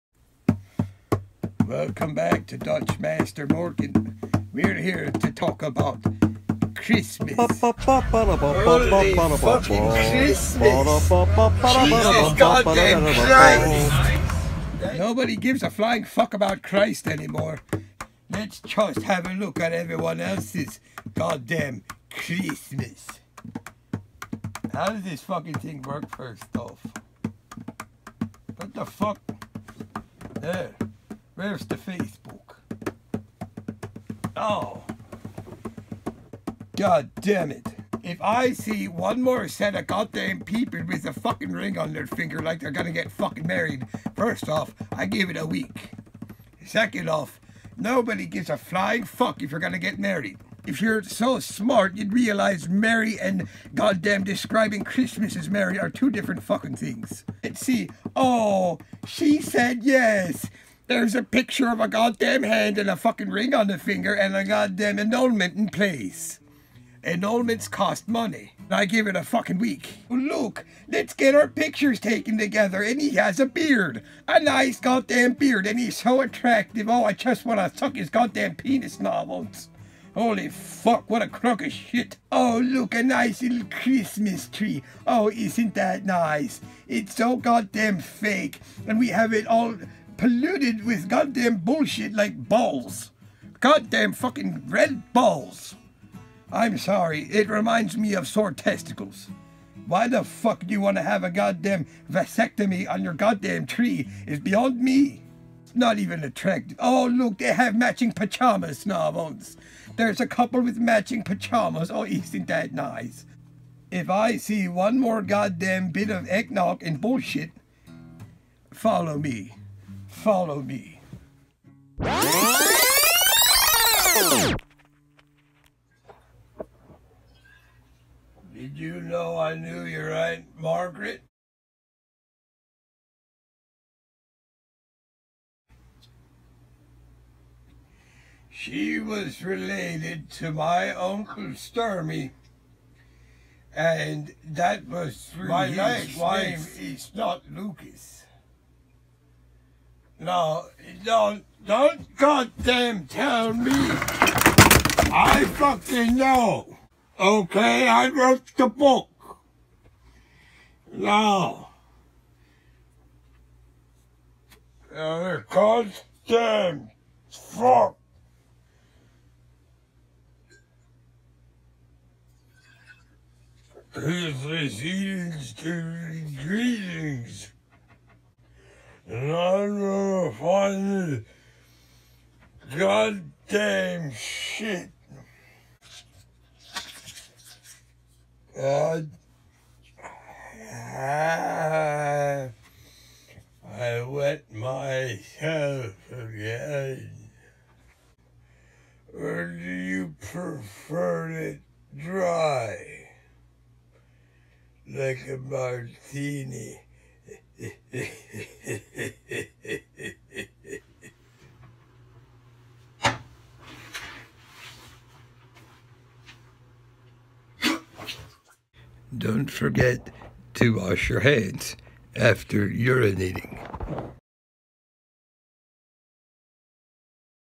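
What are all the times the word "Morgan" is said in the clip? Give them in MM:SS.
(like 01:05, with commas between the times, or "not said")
00:03.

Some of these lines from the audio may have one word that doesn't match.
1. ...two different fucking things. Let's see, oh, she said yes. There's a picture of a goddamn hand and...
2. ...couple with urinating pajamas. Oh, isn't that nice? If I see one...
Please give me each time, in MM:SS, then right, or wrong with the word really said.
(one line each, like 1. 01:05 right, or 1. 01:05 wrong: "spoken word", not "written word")
1. 00:55 right
2. 01:50 wrong: "matching", not "urinating".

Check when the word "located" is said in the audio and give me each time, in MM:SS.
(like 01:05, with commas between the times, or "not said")
not said.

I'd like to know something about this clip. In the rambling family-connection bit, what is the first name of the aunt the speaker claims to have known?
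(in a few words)
Margaret.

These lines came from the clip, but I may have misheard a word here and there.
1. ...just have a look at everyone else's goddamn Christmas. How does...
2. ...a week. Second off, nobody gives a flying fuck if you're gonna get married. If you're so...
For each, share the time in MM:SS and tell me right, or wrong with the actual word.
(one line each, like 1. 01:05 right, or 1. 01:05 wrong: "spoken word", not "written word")
1. 00:18 right
2. 00:45 right.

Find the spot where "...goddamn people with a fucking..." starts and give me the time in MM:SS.
00:39.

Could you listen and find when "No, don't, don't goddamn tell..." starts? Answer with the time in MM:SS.
02:30.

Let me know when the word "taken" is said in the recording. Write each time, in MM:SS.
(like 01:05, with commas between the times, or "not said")
01:12.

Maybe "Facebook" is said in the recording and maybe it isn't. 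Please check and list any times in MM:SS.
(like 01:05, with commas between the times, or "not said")
00:31.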